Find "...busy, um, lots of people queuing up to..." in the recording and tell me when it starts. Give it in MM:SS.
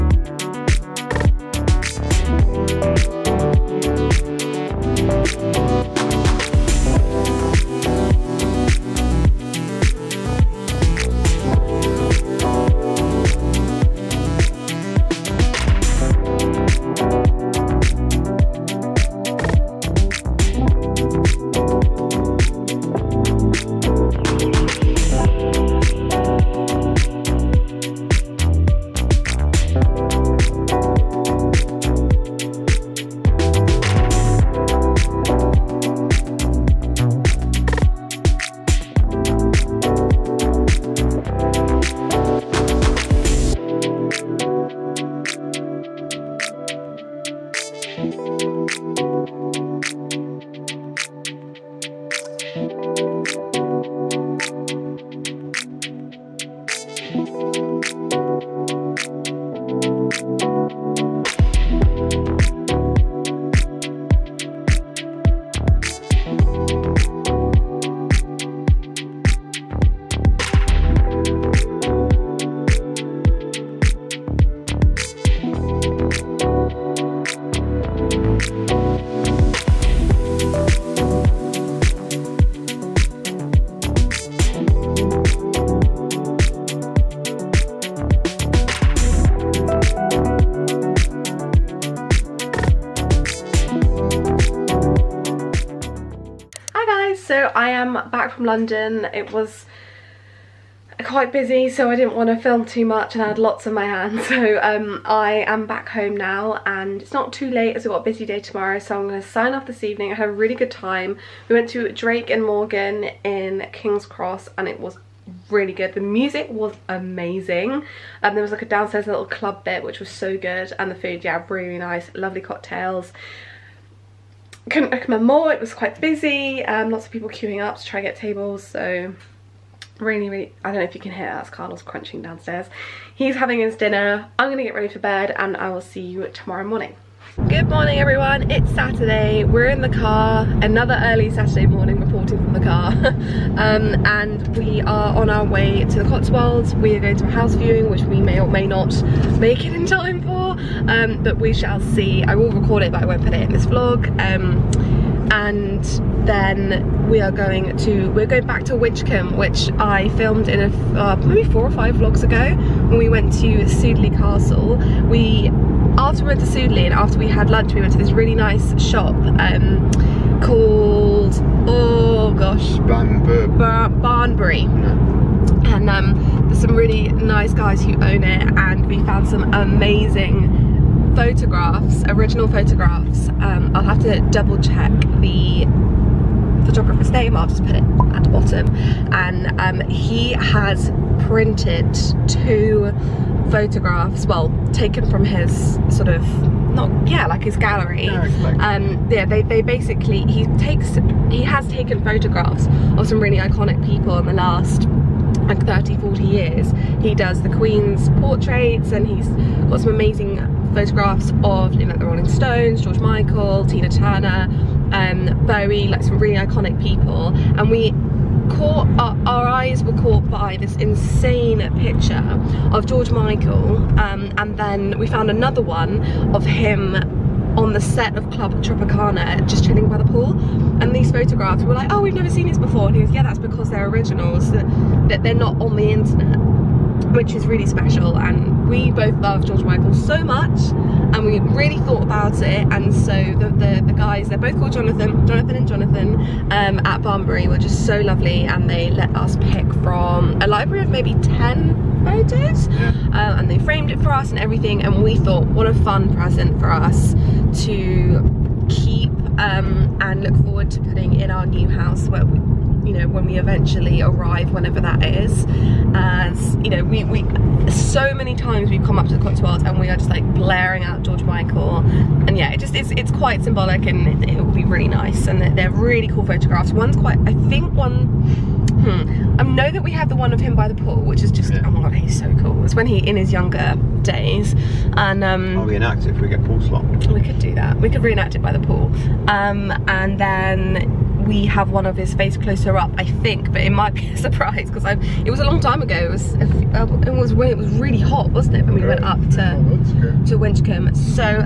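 02:06.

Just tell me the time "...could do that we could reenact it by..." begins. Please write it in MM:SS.
04:47.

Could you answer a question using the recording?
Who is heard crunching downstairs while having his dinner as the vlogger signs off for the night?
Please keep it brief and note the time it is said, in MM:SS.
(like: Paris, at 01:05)
Carlos, at 02:11.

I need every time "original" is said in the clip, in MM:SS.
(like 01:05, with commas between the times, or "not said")
03:02, 03:53.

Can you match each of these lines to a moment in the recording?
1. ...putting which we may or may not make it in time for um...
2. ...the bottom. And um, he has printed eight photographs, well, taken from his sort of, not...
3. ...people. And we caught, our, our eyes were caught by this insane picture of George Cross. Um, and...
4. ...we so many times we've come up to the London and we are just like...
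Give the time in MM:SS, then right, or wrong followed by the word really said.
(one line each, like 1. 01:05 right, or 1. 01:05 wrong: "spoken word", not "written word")
1. 02:27 wrong: "viewing", not "putting"
2. 03:08 wrong: "two", not "eight"
3. 03:36 wrong: "Michael", not "Cross"
4. 04:27 wrong: "Cotswolds", not "London".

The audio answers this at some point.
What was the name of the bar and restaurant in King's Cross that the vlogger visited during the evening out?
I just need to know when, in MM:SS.
01:51.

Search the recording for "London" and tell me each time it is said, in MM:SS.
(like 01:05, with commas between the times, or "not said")
01:38.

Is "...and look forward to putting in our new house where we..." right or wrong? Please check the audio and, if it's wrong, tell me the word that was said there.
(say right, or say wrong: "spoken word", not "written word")
right.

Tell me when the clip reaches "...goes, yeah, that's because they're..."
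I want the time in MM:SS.
03:53.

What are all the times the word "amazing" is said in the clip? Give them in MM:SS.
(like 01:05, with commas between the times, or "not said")
01:56, 02:59, 03:29.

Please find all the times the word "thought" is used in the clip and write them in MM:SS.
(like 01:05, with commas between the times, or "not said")
04:01, 04:15.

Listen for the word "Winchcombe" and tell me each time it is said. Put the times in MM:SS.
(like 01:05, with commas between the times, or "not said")
02:38, 05:00.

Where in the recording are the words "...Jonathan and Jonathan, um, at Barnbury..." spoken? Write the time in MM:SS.
04:05.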